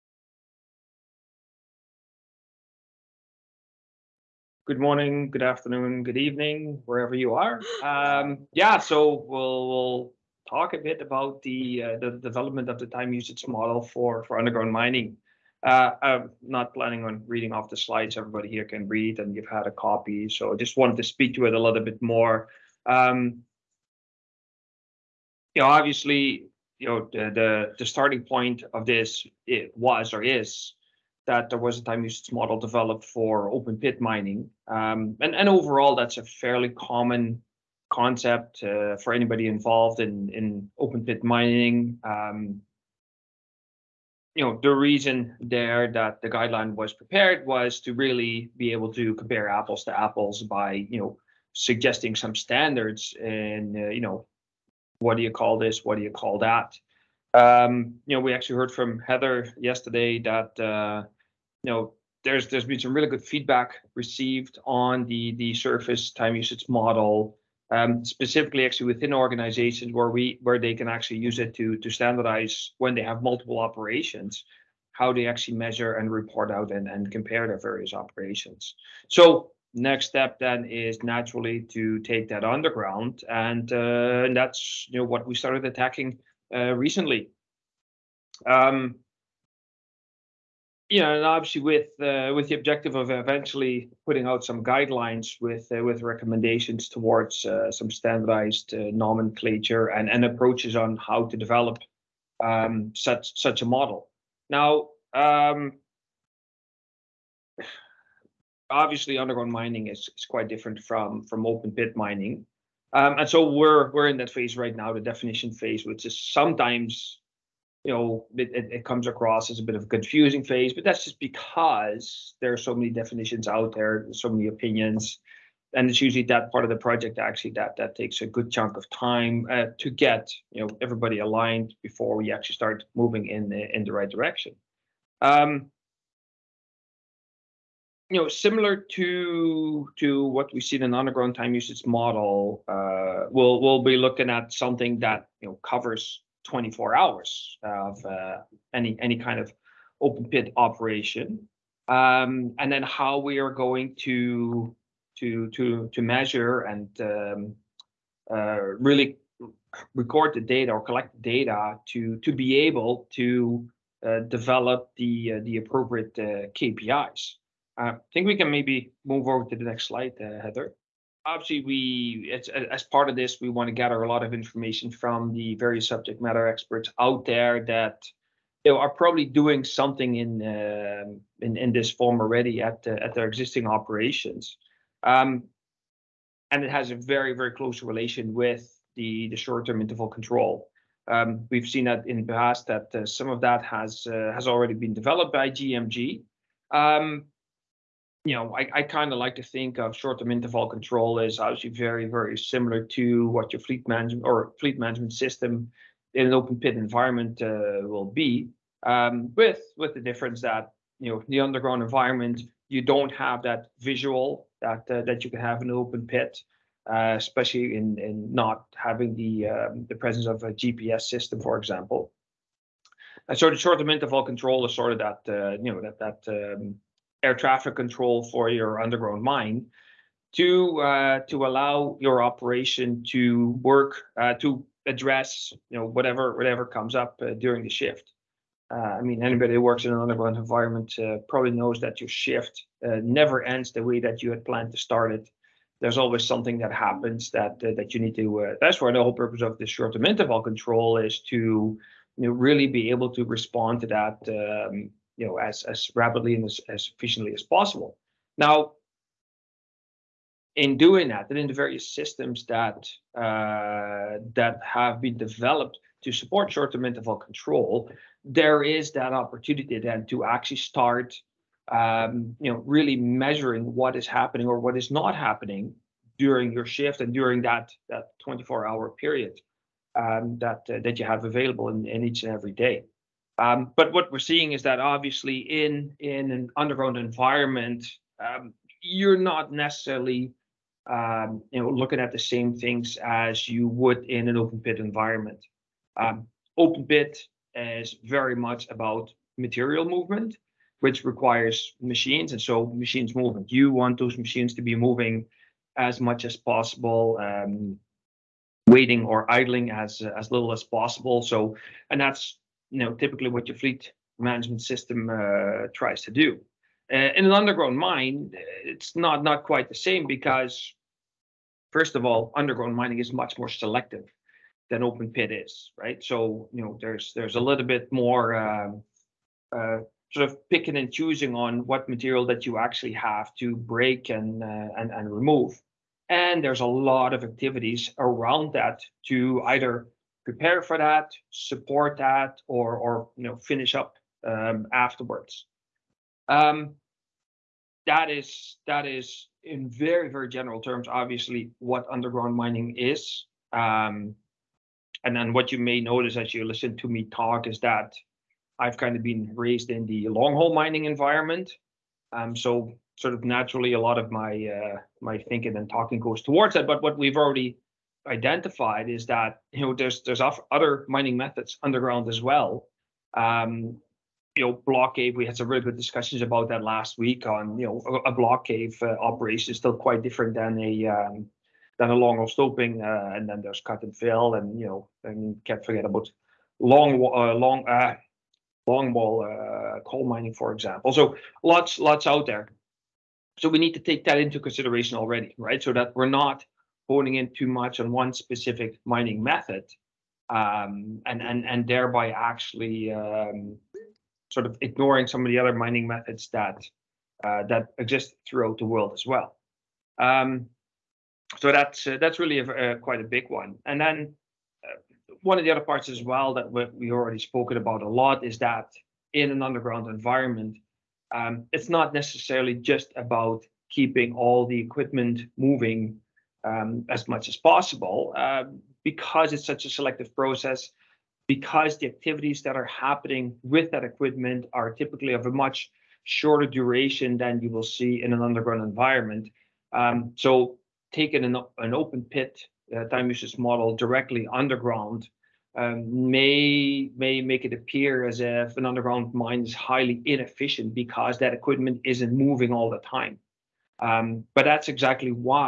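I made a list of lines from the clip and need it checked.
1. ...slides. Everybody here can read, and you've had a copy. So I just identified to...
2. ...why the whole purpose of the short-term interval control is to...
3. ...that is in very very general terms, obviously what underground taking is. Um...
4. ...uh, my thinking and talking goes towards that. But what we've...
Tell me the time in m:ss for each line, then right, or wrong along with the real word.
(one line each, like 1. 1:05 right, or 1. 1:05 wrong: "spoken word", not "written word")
1. 0:17 wrong: "wanted", not "identified"
2. 4:08 right
3. 5:48 wrong: "mining", not "taking"
4. 6:04 right.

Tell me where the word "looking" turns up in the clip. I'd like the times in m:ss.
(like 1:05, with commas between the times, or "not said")
2:23, 4:51.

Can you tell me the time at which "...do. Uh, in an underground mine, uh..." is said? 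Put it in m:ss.
5:16.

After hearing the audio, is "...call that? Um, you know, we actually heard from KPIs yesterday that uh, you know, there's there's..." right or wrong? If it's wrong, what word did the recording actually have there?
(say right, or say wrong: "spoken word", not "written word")
wrong: "Heather", not "KPIs".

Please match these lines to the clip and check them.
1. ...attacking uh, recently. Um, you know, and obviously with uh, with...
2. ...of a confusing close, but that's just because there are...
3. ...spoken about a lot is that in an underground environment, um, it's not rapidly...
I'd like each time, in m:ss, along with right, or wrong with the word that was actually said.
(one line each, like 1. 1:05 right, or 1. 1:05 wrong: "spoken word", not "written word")
1. 1:25 right
2. 1:59 wrong: "phase", not "close"
3. 6:57 wrong: "necessarily", not "rapidly".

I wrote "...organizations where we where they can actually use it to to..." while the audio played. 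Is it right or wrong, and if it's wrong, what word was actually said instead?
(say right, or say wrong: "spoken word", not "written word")
right.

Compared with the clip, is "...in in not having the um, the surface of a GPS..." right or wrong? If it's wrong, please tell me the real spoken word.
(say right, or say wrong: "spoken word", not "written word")
wrong: "presence", not "surface".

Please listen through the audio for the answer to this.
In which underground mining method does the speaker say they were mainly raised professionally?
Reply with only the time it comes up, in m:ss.
6:00.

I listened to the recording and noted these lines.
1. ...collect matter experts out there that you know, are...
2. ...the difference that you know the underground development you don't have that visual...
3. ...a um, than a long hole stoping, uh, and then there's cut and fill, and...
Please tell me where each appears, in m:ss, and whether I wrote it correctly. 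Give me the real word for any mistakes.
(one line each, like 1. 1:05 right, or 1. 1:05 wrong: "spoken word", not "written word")
1. 2:55 wrong: "subject", not "collect"
2. 3:29 wrong: "environment", not "development"
3. 6:20 right.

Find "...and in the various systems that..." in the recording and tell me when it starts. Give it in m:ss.
4:21.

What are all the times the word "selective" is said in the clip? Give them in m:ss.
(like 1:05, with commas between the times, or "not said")
5:23, 7:09.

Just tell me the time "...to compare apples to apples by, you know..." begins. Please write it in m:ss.
0:48.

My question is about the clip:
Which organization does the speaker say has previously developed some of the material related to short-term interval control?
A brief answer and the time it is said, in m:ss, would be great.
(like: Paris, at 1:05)
GMG, at 3:15.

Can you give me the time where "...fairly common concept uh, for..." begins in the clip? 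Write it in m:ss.
0:36.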